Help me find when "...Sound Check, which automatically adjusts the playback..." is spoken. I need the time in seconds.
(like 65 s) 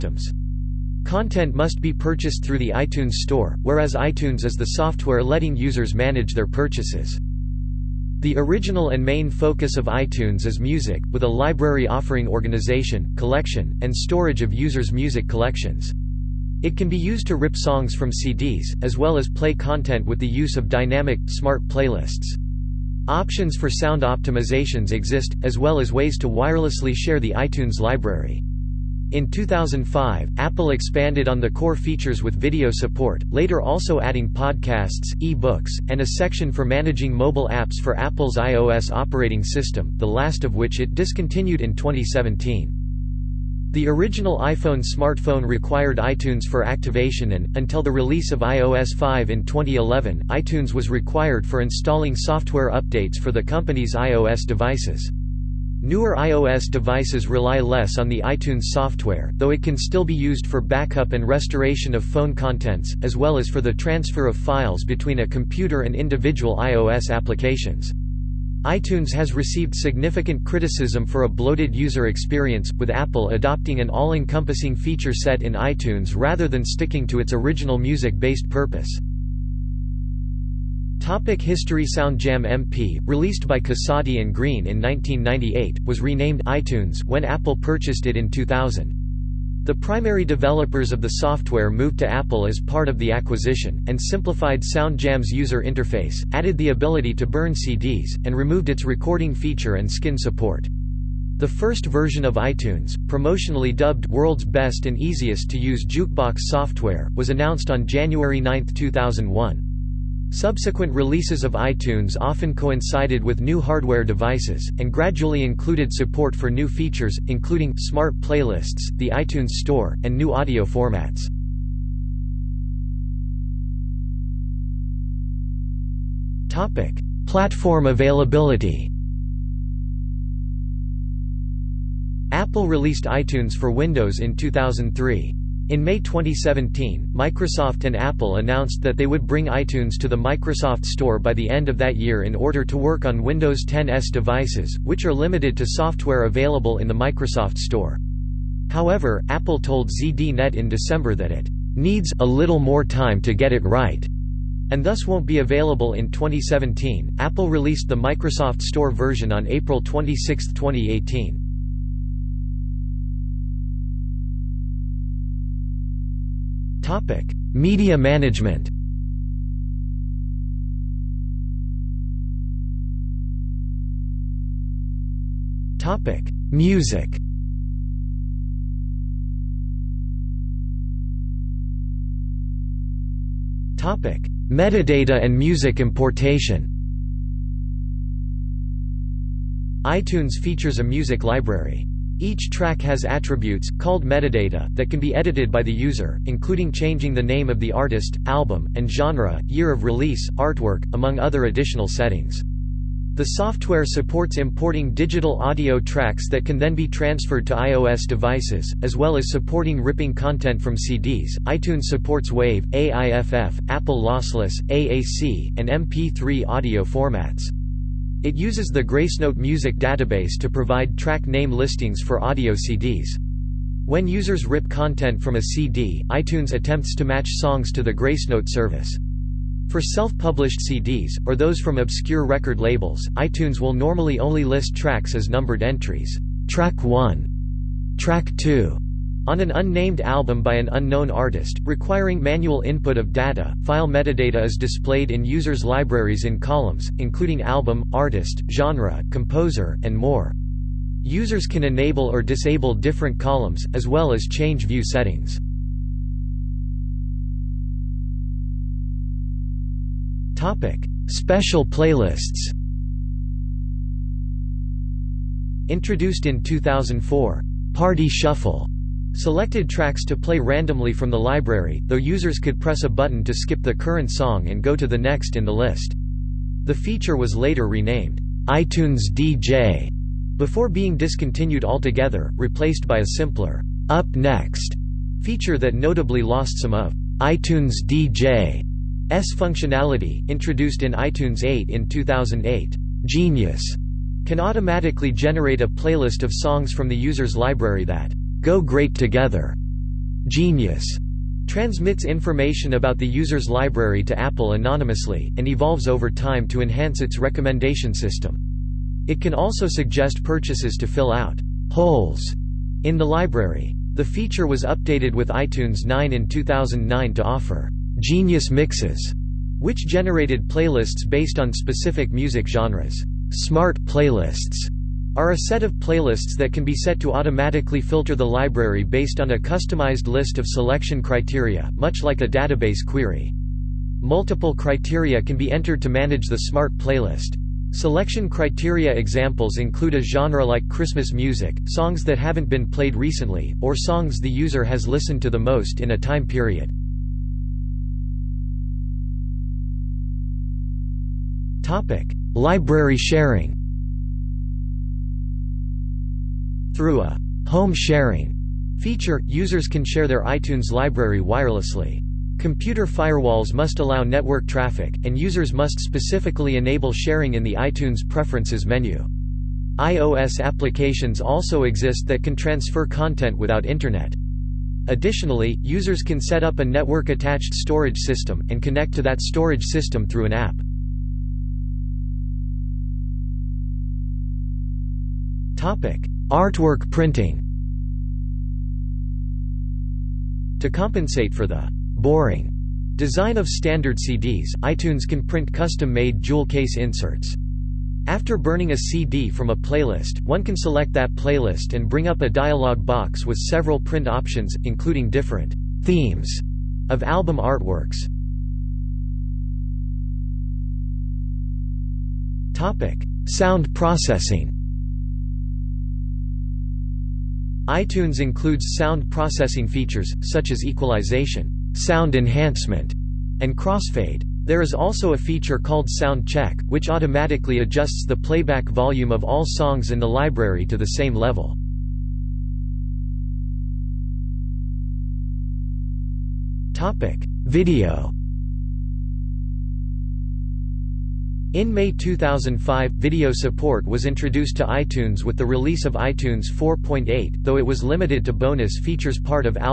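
425 s.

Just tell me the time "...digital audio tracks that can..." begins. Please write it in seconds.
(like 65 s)
204 s.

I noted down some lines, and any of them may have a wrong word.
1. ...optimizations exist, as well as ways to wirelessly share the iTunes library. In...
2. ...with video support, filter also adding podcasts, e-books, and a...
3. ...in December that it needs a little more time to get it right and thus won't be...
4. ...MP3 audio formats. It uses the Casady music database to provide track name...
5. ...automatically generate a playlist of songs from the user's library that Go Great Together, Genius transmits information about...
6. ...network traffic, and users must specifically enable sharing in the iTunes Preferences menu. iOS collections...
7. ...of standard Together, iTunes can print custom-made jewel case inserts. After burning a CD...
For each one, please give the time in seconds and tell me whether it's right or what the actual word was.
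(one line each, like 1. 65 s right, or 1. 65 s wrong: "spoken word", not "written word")
1. 24 s right
2. 32 s wrong: "later", not "filter"
3. 150 s right
4. 215 s wrong: "Gracenote", not "Casady"
5. 294 s right
6. 364 s wrong: "applications", not "collections"
7. 393 s wrong: "CDs", not "Together".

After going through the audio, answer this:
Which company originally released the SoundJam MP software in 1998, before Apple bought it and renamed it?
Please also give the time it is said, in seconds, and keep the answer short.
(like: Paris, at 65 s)
Casady and Greene, at 83 s.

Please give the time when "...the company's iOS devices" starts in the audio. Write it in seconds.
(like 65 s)
53 s.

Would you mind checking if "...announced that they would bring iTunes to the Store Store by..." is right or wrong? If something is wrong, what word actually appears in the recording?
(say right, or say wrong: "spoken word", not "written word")
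wrong: "Microsoft", not "Store".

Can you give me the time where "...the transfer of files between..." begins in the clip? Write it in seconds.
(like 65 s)
63 s.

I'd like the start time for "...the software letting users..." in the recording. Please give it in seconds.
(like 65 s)
4 s.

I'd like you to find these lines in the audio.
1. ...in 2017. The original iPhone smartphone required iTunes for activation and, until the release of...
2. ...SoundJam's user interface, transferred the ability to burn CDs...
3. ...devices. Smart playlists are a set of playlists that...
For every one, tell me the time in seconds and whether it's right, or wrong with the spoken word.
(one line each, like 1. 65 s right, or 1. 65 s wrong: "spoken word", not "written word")
1. 41 s right
2. 94 s wrong: "added", not "transferred"
3. 322 s wrong: "genres", not "devices".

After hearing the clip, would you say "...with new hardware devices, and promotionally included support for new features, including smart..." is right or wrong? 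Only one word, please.
wrong.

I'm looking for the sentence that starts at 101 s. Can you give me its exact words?
The first version of iTunes, promotionally dubbed World's Best and Easiest to Use Jukebox Software, was announced on January 9, 2001.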